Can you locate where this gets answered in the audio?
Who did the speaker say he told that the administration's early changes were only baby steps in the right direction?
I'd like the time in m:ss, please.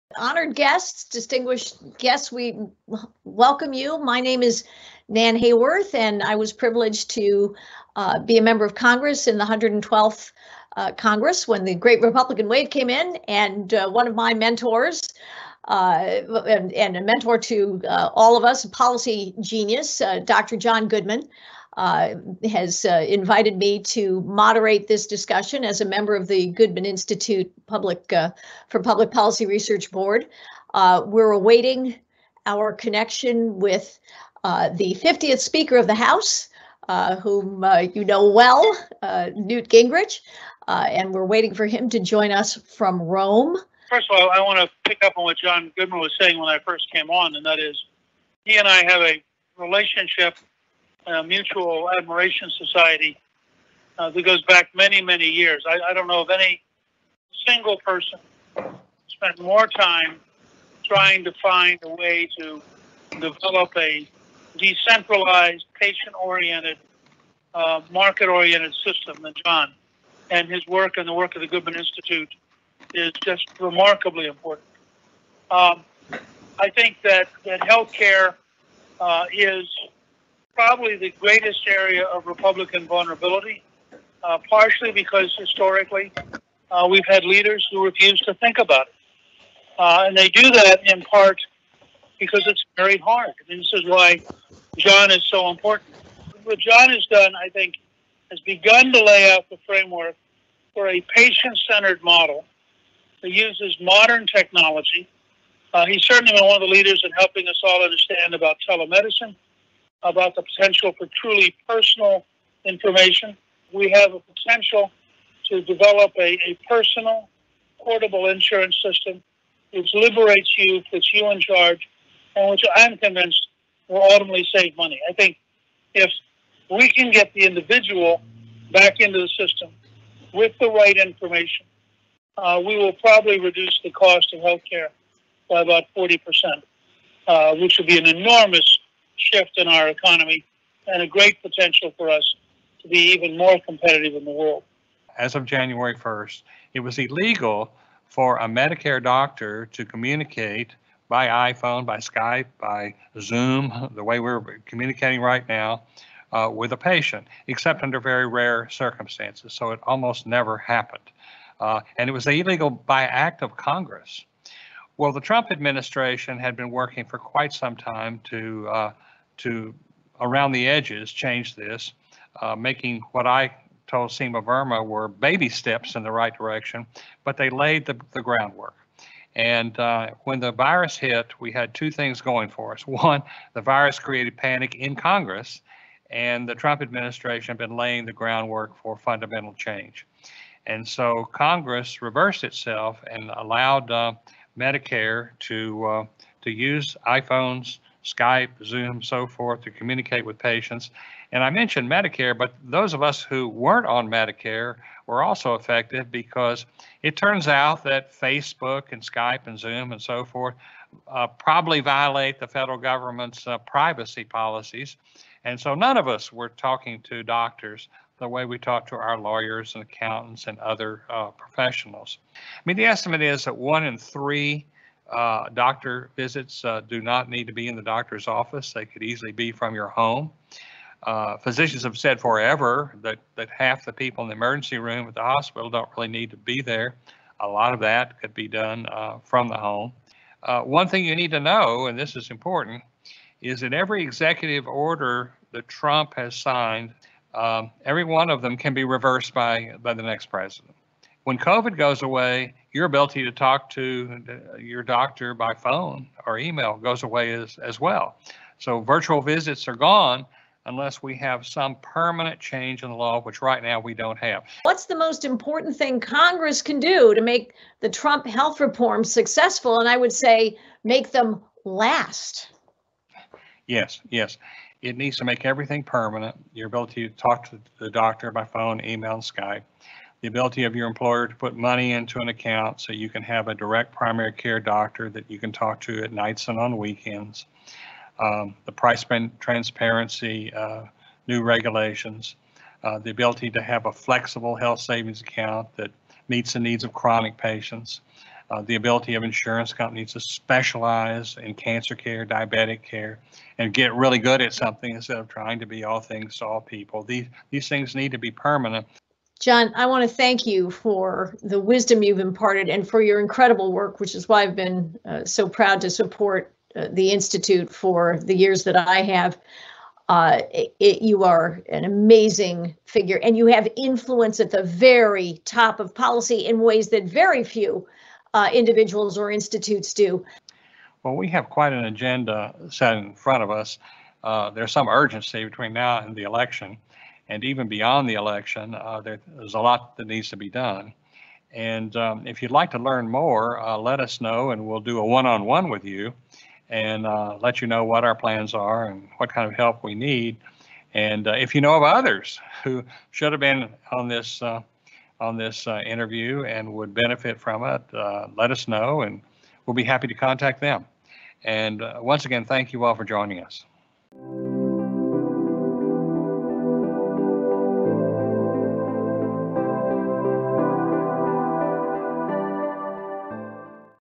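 2:54.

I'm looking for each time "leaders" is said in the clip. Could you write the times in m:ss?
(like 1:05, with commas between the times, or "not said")
1:27, 1:46.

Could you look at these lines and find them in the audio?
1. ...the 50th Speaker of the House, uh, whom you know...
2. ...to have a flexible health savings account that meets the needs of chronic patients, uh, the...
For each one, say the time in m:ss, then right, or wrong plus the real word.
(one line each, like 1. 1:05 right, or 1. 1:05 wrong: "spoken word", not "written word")
1. 0:34 right
2. 4:53 right.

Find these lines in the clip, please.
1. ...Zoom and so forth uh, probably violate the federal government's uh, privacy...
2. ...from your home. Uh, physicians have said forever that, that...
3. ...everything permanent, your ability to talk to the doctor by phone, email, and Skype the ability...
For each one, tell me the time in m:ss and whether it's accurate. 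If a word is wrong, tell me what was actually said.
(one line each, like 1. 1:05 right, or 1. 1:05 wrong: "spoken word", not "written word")
1. 3:29 right
2. 3:49 right
3. 4:35 right.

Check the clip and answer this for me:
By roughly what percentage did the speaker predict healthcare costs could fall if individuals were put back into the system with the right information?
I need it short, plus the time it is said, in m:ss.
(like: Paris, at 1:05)
40%, at 2:15.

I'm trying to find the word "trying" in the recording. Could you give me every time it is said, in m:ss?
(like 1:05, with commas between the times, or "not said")
1:00, 5:05.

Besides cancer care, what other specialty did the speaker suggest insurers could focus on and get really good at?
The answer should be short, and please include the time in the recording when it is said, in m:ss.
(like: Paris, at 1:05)
diabetic care, at 5:02.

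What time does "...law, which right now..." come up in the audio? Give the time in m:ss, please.
4:22.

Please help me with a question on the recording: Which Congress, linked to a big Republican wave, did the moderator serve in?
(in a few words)
112th.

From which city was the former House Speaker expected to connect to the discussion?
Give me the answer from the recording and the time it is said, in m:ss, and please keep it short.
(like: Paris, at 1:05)
Rome, at 0:43.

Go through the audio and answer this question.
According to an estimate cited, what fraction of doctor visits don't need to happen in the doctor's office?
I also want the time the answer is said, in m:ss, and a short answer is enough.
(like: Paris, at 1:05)
one in three, at 3:43.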